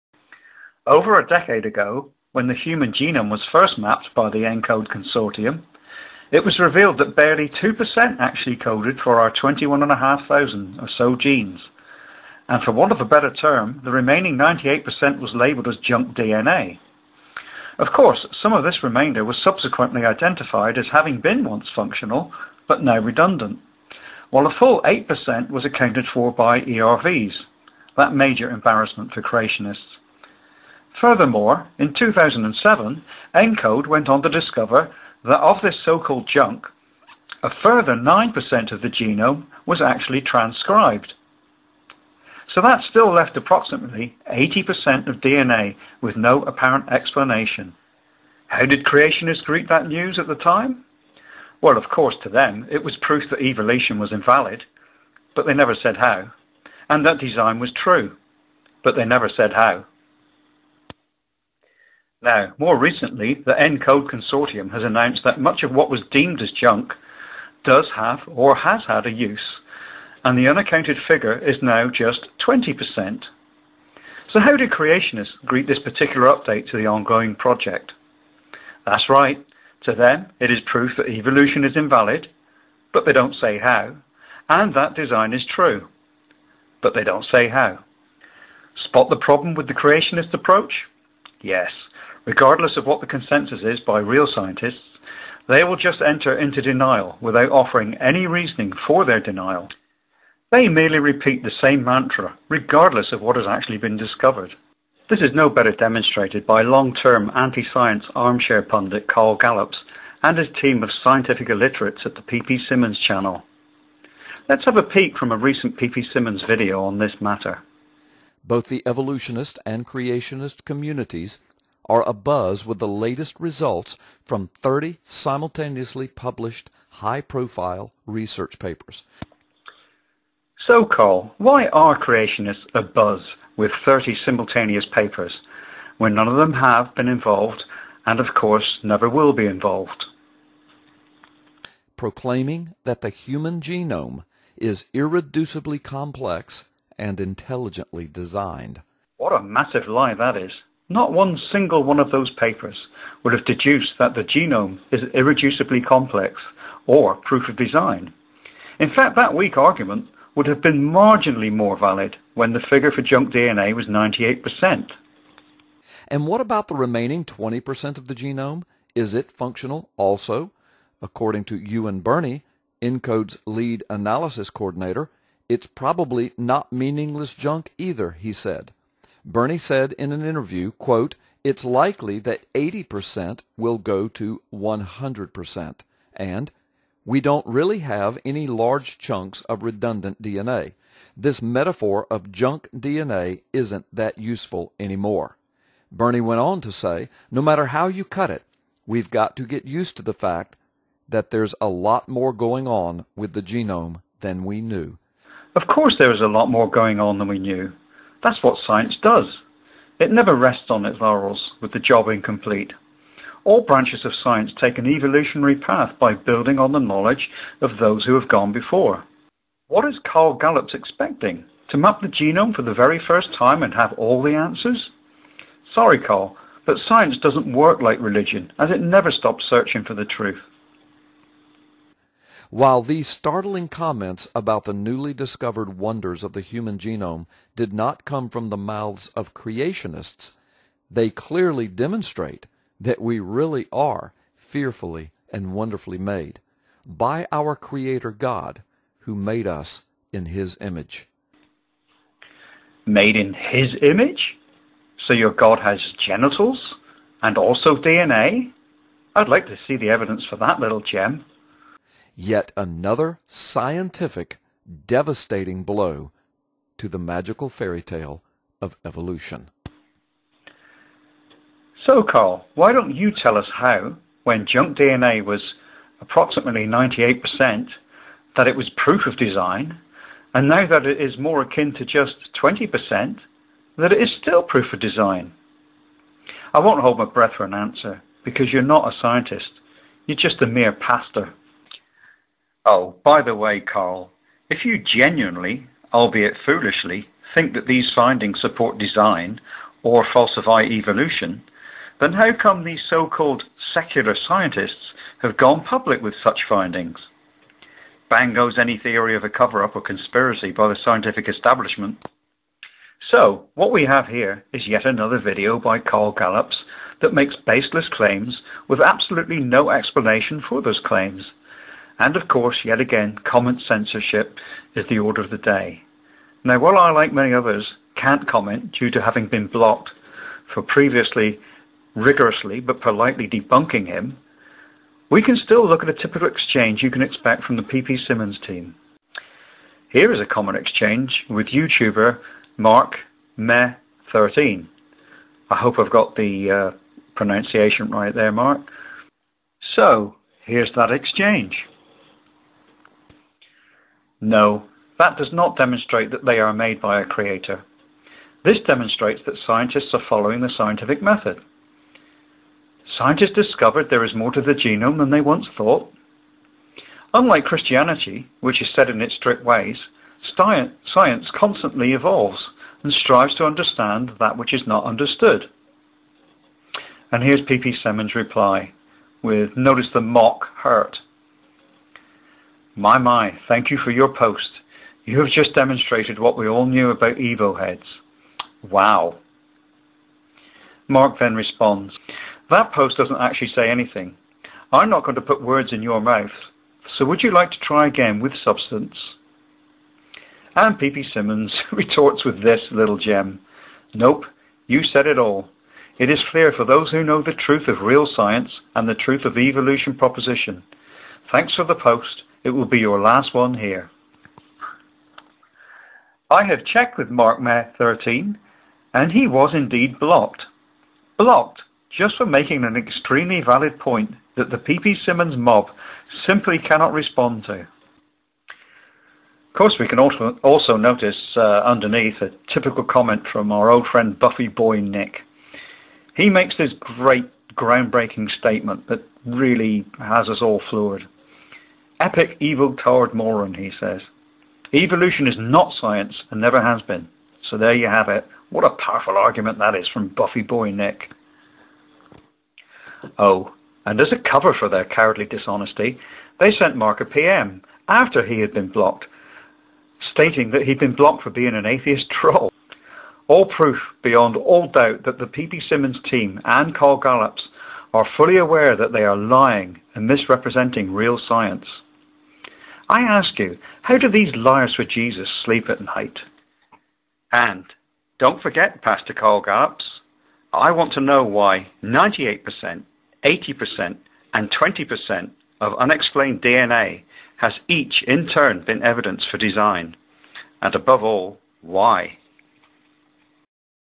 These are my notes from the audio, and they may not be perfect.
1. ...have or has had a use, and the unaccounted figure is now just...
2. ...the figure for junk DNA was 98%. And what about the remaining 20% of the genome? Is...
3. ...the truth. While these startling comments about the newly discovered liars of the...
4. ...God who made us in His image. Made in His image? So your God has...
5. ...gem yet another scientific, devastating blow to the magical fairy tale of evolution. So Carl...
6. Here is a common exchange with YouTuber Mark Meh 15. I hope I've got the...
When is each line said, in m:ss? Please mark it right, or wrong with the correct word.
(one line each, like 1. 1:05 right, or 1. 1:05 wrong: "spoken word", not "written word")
1. 1:07 right
2. 2:42 right
3. 3:49 wrong: "wonders", not "liars"
4. 4:08 right
5. 4:20 right
6. 5:39 wrong: "13", not "15".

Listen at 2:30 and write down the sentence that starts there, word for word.
Not one single one of those papers would have deduced that the genome is irreducibly complex or proof of design.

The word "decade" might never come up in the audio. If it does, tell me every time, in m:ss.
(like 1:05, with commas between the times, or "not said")
0:01.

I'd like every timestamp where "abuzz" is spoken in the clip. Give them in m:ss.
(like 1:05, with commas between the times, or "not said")
2:02, 2:12.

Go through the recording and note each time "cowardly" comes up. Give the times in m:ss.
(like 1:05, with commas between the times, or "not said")
7:34.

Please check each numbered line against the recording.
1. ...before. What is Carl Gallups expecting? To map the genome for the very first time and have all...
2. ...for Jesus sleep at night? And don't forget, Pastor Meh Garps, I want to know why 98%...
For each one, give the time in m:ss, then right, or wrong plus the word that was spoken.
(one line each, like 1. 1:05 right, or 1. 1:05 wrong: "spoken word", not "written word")
1. 3:38 right
2. 7:54 wrong: "Carl", not "Meh".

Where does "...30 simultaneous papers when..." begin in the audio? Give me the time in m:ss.
2:13.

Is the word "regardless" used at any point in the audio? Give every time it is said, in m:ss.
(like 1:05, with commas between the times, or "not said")
1:32, 1:42.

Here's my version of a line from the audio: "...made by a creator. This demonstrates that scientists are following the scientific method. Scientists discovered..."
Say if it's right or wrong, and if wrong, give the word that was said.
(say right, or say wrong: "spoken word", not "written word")
right.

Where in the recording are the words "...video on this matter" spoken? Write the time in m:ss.
1:56.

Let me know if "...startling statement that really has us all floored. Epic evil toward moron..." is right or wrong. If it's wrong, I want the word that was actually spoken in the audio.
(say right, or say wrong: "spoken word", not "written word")
wrong: "groundbreaking", not "startling".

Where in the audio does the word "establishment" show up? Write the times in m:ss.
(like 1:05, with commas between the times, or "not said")
5:11.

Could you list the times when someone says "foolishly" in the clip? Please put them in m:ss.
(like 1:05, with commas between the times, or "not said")
4:56.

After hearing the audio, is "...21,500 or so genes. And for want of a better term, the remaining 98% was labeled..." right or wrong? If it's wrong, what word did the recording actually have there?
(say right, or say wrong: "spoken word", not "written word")
right.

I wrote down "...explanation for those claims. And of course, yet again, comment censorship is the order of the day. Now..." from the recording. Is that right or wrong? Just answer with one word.
right.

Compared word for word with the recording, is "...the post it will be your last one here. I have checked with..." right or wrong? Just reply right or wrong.
right.